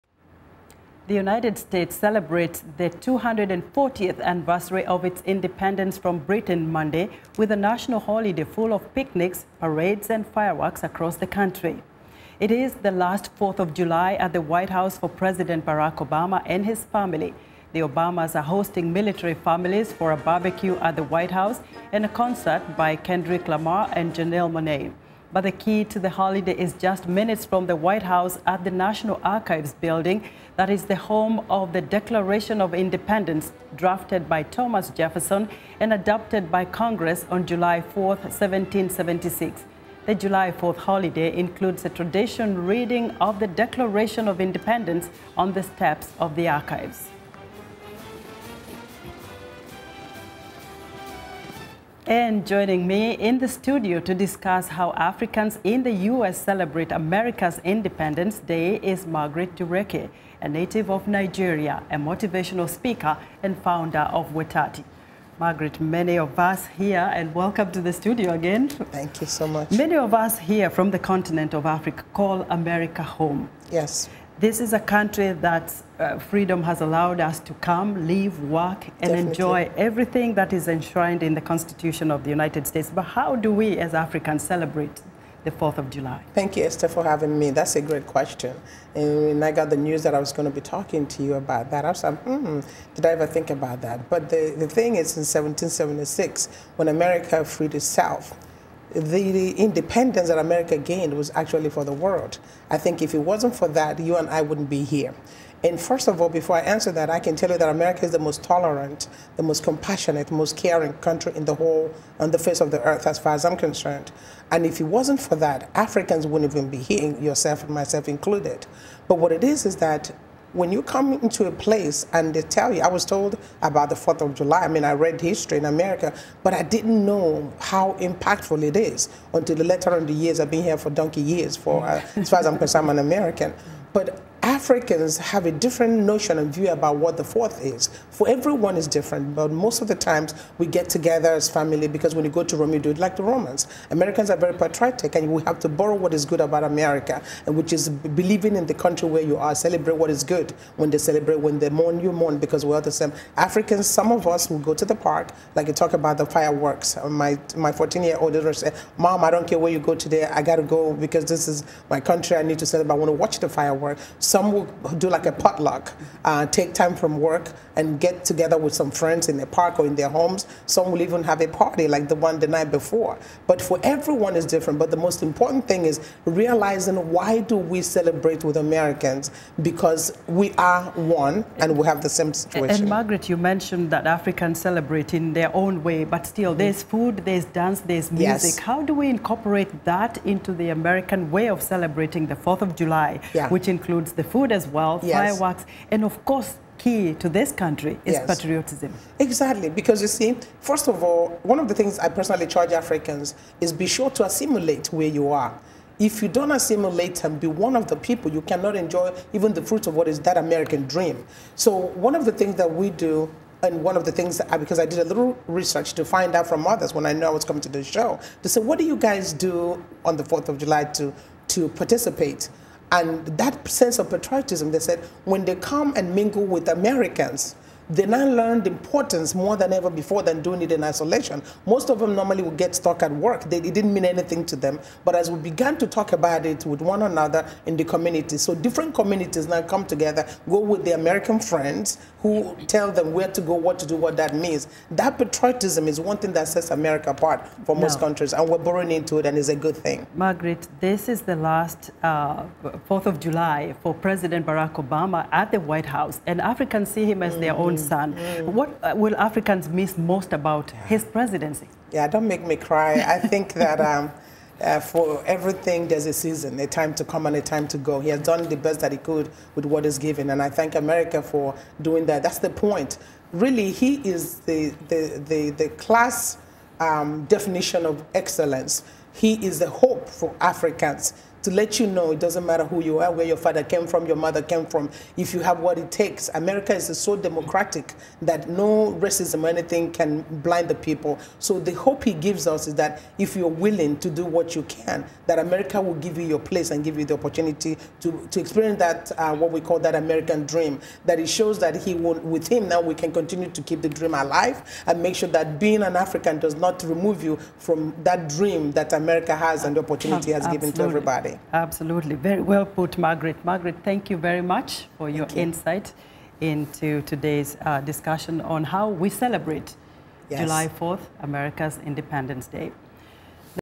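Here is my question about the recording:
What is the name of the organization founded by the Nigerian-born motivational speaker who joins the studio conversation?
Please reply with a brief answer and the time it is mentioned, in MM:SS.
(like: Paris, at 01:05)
Wetati, at 01:04.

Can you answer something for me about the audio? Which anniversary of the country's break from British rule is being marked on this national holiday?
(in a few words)
240th.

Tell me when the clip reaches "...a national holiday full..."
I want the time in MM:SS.
00:07.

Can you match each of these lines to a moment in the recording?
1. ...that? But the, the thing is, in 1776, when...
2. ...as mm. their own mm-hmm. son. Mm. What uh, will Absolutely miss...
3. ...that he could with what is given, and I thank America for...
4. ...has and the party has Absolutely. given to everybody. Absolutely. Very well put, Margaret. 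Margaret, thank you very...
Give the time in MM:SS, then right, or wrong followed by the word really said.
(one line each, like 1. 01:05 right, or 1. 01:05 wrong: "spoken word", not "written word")
1. 01:33 right
2. 04:17 wrong: "Africans", not "Absolutely"
3. 04:28 right
4. 05:09 wrong: "opportunity", not "party".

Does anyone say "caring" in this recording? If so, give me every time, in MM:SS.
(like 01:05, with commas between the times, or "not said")
01:50.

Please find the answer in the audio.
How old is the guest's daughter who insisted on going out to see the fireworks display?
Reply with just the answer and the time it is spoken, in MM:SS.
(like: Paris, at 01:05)
14, at 02:37.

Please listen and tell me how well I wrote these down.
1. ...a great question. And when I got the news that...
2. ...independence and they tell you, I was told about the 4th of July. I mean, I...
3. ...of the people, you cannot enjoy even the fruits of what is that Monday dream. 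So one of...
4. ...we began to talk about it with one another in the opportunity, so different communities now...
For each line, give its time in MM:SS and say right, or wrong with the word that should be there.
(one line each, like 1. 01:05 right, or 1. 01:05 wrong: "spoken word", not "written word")
1. 01:27 right
2. 02:01 wrong: "place", not "independence"
3. 03:27 wrong: "American", not "Monday"
4. 03:55 wrong: "community", not "opportunity".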